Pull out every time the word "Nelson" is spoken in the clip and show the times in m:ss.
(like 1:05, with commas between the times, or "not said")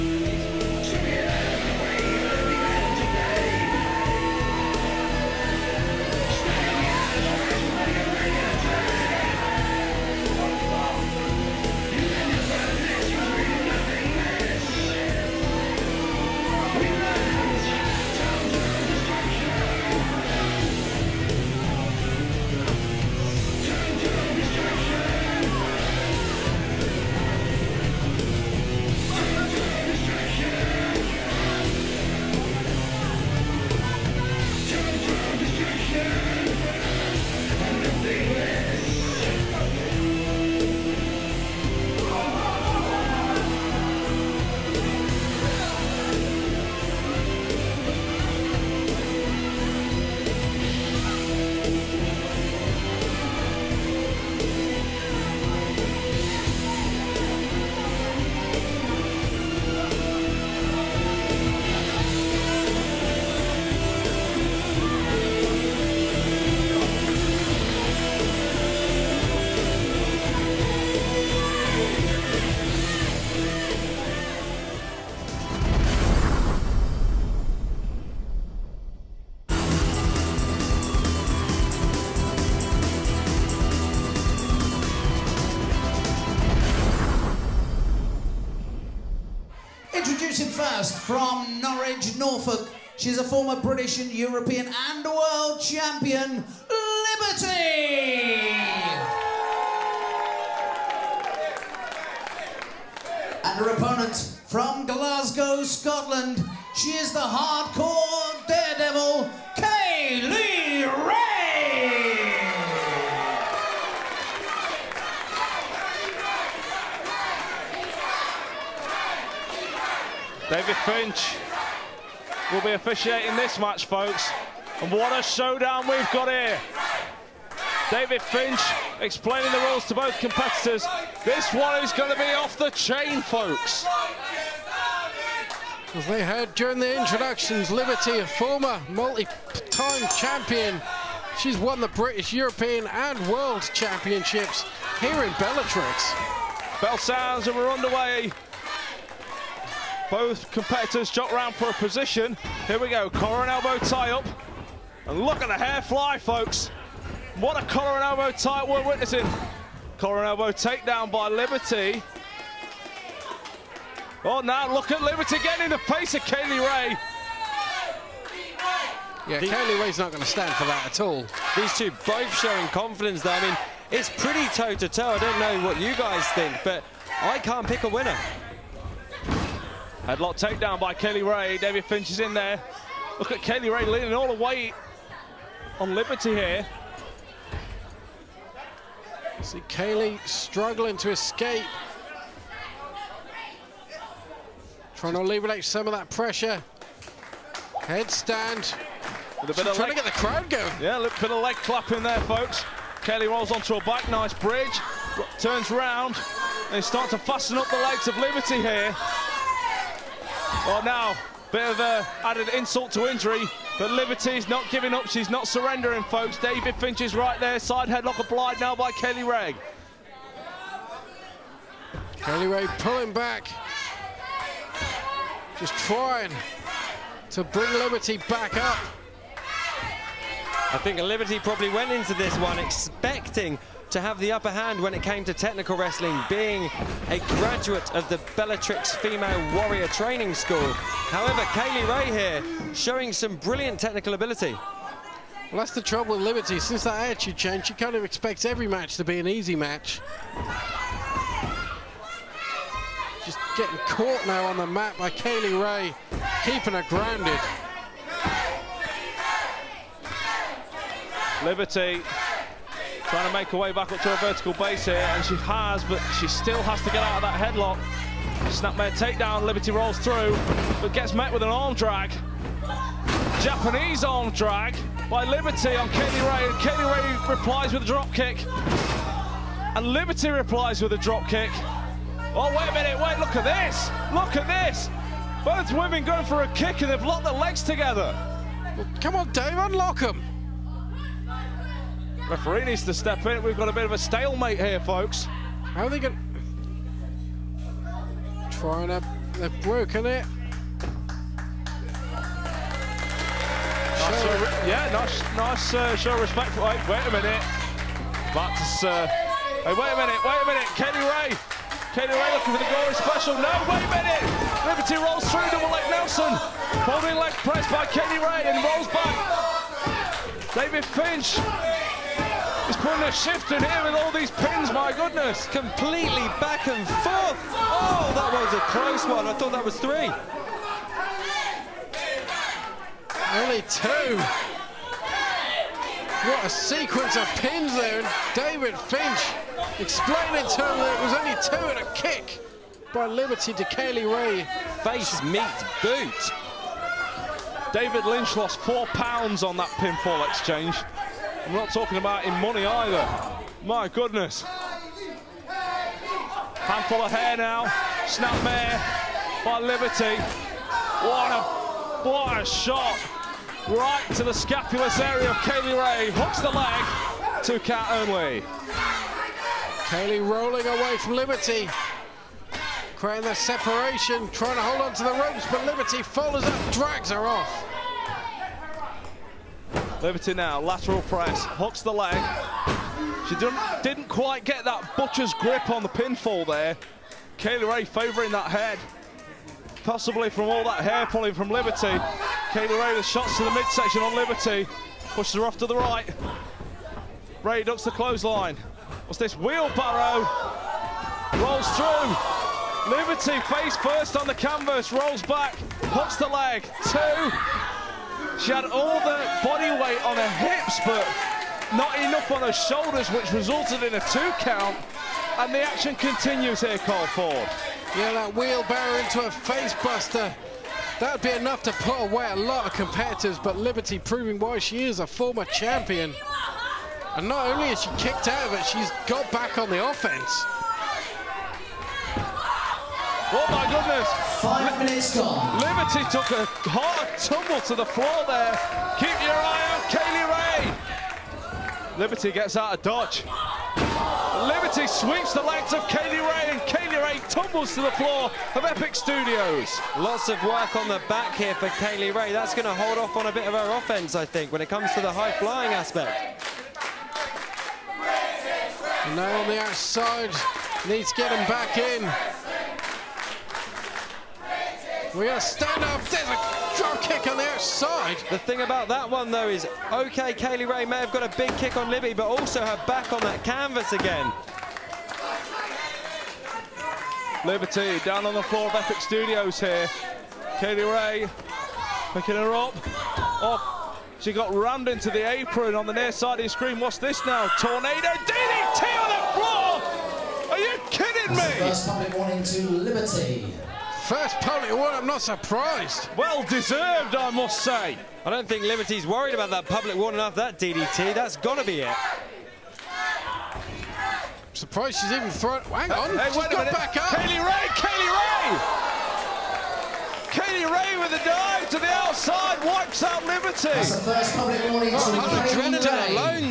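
5:15.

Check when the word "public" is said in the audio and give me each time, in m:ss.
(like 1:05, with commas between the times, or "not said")
8:11, 8:19, 8:34.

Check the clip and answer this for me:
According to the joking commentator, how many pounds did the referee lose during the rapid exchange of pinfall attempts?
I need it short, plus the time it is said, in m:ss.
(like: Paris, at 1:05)
4, at 5:48.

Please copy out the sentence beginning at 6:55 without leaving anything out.
And the action continues here, Cole Ford.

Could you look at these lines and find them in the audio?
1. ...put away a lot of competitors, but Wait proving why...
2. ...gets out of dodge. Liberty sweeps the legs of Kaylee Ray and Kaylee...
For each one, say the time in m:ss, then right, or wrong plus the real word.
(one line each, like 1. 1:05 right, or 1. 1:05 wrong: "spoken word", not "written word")
1. 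7:01 wrong: "Liberty", not "Wait"
2. 7:22 right.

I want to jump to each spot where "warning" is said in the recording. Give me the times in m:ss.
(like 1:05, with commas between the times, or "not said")
8:12, 8:19, 8:34.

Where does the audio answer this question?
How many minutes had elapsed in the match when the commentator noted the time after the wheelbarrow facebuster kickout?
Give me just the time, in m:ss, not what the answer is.
7:14.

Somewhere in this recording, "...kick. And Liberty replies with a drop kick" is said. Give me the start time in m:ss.
4:38.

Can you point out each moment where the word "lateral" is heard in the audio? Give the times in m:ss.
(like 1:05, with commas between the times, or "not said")
6:20.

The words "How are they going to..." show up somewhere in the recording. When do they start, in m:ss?
4:55.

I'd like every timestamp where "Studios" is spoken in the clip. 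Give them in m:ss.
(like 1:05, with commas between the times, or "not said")
7:28, 7:58.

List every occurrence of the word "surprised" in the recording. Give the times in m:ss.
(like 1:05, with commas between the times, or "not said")
8:15, 8:24.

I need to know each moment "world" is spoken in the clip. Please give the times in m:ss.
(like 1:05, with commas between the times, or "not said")
1:35, 2:23.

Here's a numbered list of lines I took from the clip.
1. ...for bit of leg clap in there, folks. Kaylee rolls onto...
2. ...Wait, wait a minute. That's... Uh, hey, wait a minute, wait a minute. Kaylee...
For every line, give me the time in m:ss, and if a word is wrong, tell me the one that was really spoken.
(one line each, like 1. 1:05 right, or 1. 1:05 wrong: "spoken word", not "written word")
1. 3:21 right
2. 5:06 right.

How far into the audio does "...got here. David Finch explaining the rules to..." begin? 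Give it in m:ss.
2:06.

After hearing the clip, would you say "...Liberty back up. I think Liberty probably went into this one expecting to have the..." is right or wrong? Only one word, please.
right.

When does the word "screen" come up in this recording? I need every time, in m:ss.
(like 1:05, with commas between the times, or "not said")
8:06.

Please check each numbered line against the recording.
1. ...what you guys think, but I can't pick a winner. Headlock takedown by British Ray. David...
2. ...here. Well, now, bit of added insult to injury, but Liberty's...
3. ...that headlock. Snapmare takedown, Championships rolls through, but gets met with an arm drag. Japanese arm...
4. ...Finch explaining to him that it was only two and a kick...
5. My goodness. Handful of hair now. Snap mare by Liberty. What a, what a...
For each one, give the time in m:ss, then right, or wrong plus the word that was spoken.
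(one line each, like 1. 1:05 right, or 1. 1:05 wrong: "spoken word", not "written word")
1. 2:55 wrong: "Kaylee", not "British"
2. 3:28 right
3. 4:27 wrong: "Liberty", not "Championships"
4. 5:38 right
5. 5:53 right.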